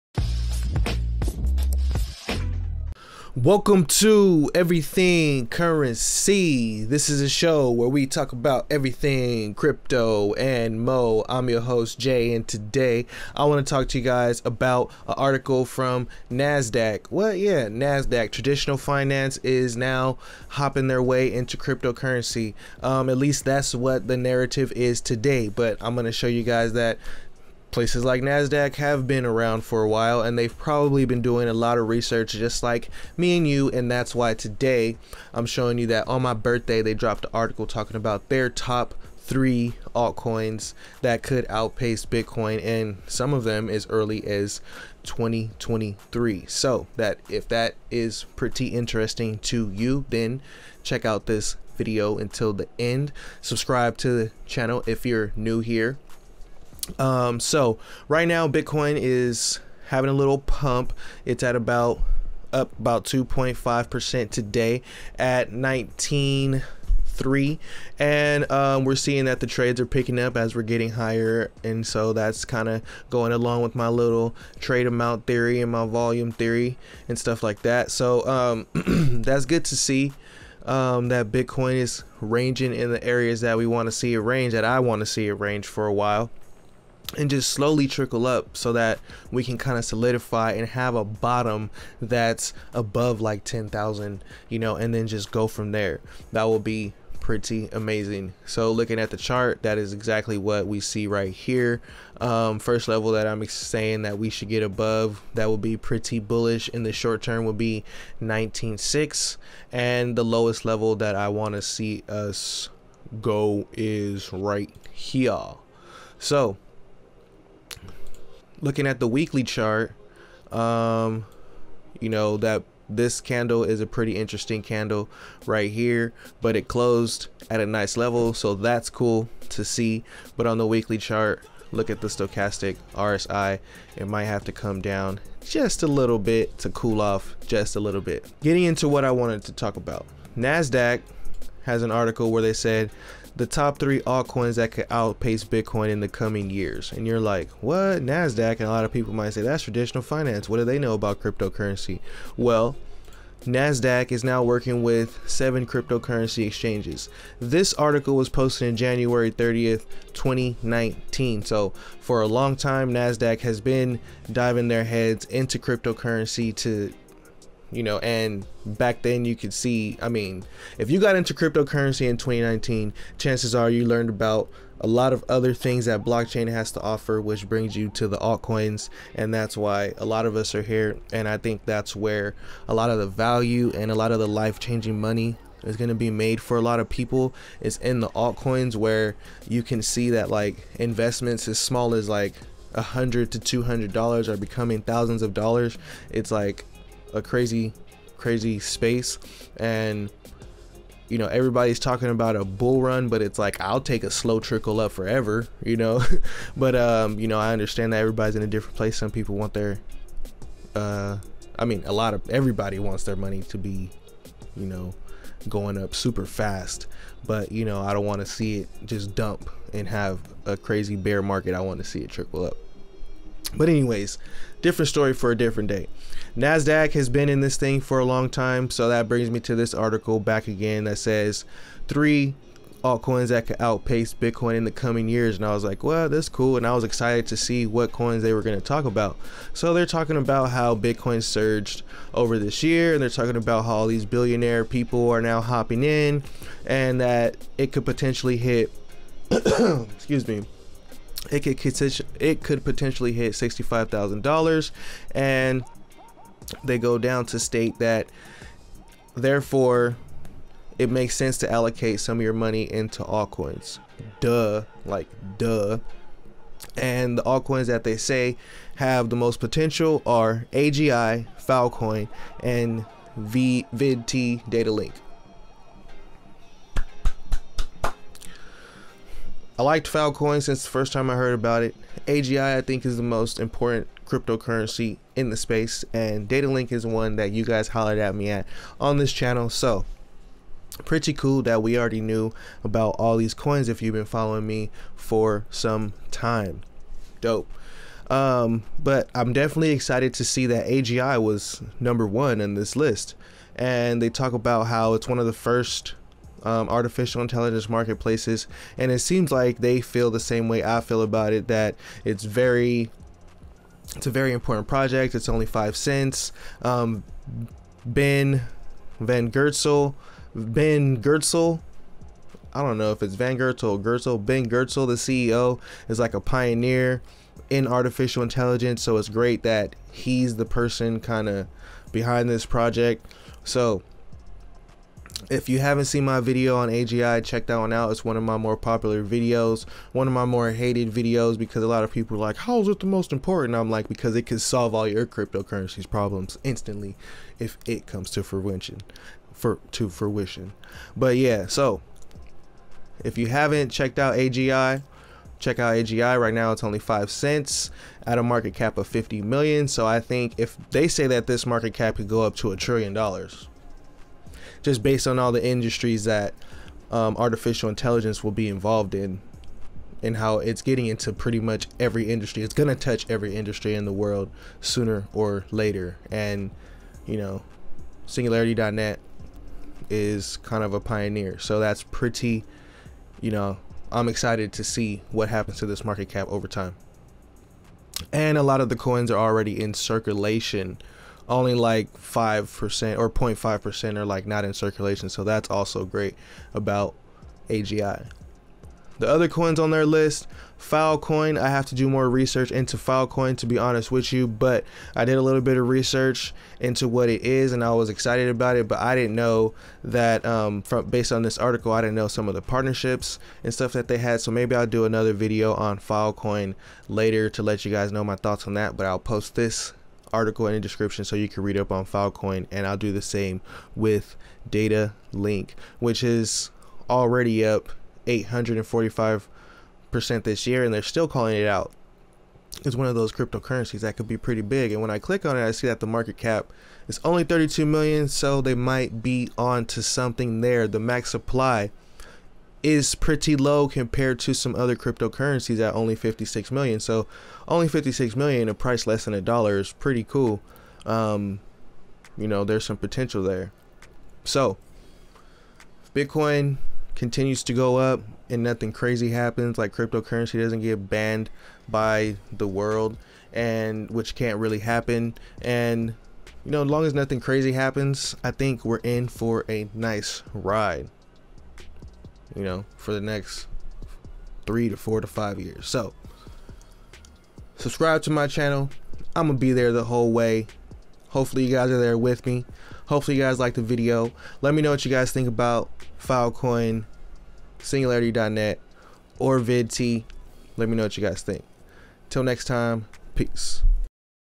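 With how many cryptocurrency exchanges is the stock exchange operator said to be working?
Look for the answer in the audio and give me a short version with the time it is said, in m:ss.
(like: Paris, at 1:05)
7, at 2:35.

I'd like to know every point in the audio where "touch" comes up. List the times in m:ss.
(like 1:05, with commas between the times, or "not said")
6:12.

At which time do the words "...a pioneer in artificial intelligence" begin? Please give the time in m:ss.
5:26.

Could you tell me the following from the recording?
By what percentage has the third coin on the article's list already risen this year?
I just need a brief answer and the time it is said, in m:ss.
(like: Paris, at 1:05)
845%, at 7:08.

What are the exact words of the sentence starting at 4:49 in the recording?
So, pretty cool that we already knew about all these coins if you've been following me for some time.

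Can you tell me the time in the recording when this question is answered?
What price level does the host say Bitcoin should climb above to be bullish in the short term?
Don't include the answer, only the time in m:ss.
1:48.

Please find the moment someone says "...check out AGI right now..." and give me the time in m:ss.
5:55.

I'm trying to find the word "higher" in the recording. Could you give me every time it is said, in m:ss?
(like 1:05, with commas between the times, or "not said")
1:10.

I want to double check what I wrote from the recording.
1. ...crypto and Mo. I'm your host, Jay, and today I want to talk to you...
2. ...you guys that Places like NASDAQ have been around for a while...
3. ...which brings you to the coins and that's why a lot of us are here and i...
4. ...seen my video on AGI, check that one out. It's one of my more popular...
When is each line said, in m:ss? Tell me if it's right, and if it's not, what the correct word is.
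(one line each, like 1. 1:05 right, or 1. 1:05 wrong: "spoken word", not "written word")
1. 0:09 right
2. 0:26 right
3. 2:57 wrong: "altcoins", not "coins"
4. 5:35 right.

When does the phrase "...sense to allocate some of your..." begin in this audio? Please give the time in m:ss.
4:21.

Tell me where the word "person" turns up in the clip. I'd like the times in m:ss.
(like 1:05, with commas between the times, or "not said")
5:30.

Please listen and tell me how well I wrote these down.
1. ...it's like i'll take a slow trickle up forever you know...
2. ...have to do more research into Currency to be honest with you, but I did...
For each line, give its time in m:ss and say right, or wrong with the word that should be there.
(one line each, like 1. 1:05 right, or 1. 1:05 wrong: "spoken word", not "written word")
1. 3:23 right
2. 6:41 wrong: "Filecoin", not "Currency".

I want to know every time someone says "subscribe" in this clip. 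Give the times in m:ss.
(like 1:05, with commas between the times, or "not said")
0:53, 7:57.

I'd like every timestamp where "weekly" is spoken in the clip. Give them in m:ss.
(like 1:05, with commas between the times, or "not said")
1:59, 2:10.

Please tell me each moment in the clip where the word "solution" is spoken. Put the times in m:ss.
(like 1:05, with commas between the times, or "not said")
not said.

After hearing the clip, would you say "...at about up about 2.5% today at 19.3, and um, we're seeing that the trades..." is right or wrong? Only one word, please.
right.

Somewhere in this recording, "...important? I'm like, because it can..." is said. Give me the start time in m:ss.
5:43.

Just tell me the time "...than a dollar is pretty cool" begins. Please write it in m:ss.
7:29.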